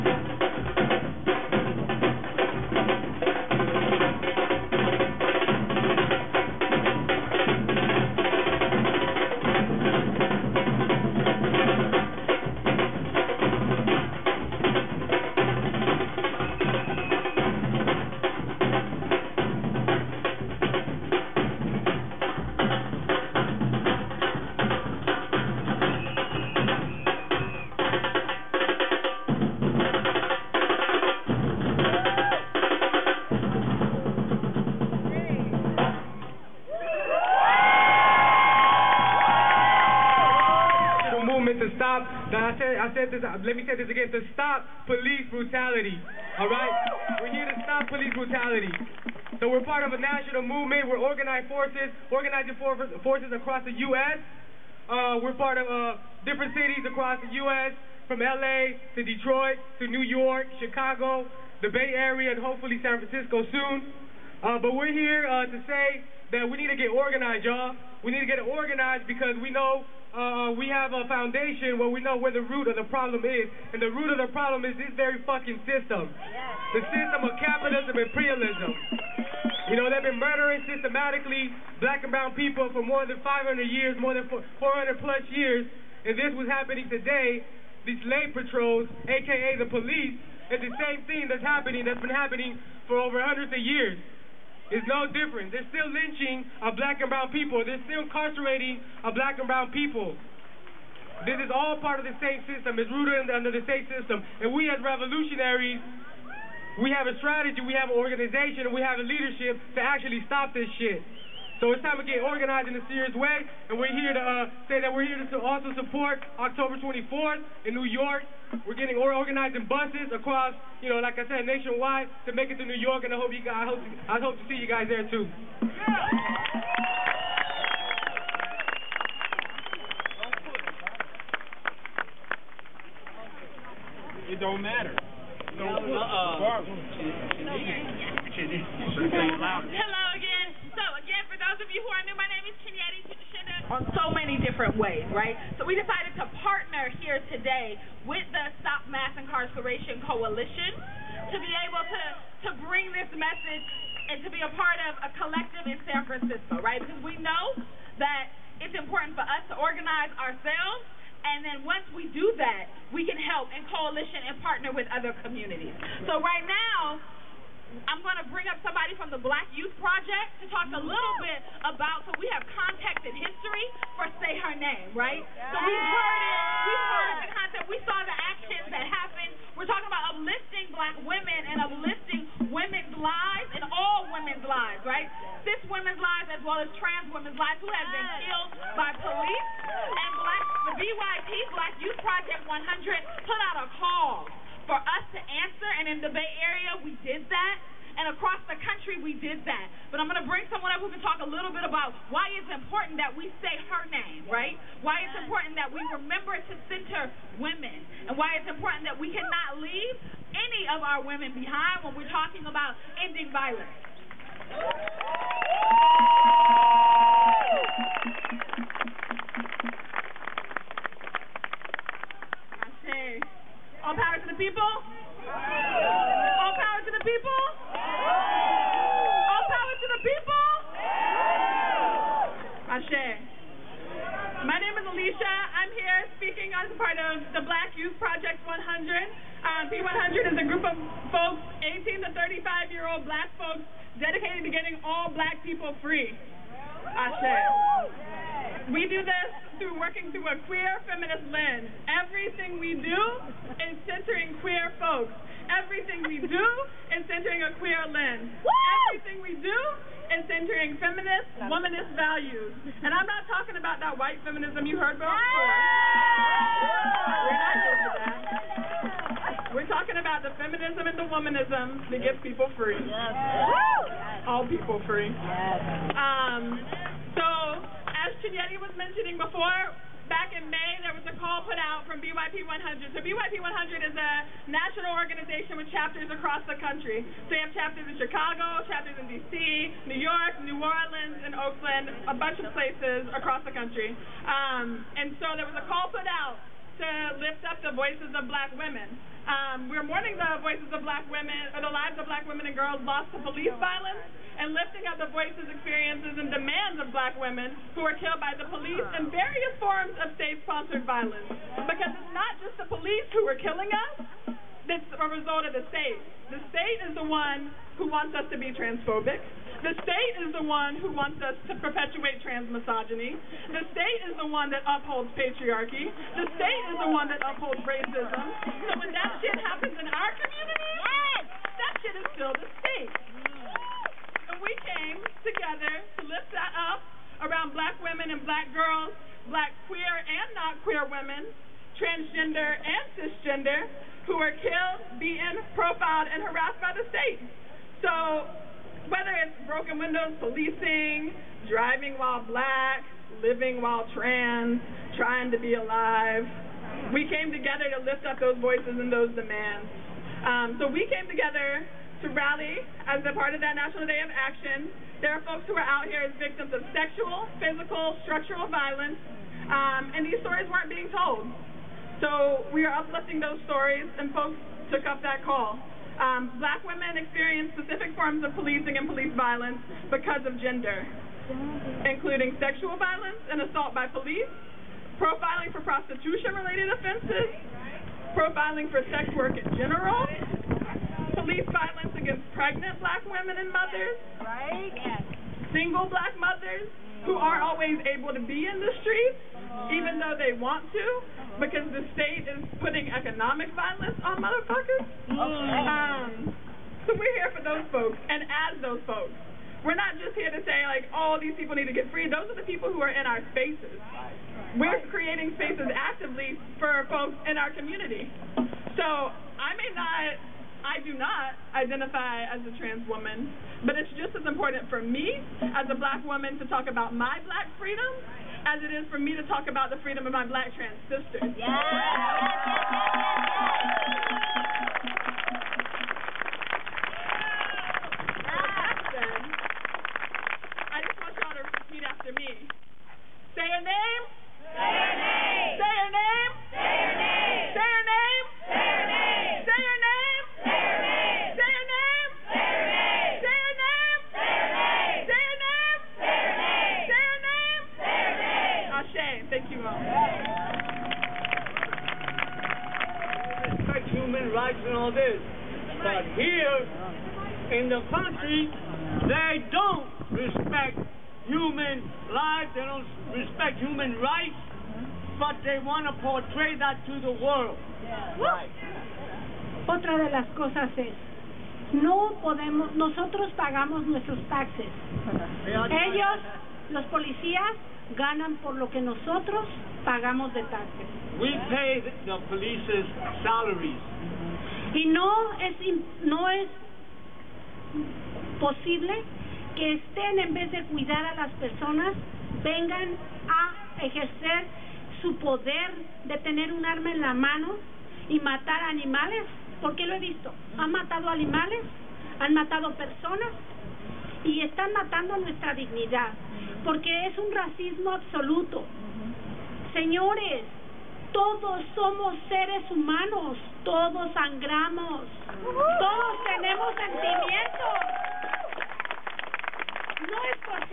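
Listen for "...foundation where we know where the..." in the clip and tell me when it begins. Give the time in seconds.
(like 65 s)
71 s.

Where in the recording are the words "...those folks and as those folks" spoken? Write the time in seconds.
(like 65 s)
407 s.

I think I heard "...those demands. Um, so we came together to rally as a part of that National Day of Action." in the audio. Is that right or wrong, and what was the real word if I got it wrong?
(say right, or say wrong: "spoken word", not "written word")
right.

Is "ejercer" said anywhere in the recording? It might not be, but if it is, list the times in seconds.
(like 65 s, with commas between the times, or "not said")
503 s.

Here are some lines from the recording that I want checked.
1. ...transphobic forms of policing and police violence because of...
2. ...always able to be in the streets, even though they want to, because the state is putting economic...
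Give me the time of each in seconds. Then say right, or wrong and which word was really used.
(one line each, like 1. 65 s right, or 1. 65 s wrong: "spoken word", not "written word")
1. 377 s wrong: "specific", not "transphobic"
2. 397 s right.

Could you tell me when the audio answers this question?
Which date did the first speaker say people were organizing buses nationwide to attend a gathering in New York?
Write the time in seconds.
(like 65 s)
116 s.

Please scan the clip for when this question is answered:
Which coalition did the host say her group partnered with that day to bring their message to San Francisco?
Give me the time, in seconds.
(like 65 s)
148 s.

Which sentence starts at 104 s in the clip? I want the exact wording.
And we as revolutionaries, we have a strategy, we have an organization, and we have a leadership to actually stop this shit.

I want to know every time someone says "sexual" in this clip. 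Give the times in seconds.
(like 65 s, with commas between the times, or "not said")
366 s, 382 s.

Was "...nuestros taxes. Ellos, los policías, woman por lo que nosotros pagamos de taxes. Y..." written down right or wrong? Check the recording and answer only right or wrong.
wrong.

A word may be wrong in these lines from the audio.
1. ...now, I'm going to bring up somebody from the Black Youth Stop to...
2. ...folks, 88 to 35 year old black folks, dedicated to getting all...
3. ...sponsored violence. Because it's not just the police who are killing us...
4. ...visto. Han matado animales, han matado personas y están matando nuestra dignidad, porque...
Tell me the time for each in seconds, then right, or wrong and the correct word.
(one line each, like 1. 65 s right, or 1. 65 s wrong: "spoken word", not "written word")
1. 166 s wrong: "Project", not "Stop"
2. 241 s wrong: "18", not "88"
3. 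310 s right
4. 509 s right.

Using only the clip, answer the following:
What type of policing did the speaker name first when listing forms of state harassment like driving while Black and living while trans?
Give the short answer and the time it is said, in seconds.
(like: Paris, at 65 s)
Broken windows, at 349 s.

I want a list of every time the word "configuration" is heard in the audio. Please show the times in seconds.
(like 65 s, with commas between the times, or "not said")
not said.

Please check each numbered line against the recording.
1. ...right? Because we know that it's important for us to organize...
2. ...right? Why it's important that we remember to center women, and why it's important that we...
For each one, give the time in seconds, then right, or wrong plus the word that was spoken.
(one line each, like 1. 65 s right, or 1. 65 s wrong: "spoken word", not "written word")
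1. 156 s right
2. 204 s right.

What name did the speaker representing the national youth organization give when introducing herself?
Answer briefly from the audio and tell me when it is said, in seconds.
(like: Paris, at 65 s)
Alicia, at 234 s.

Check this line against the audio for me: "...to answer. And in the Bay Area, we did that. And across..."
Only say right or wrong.
right.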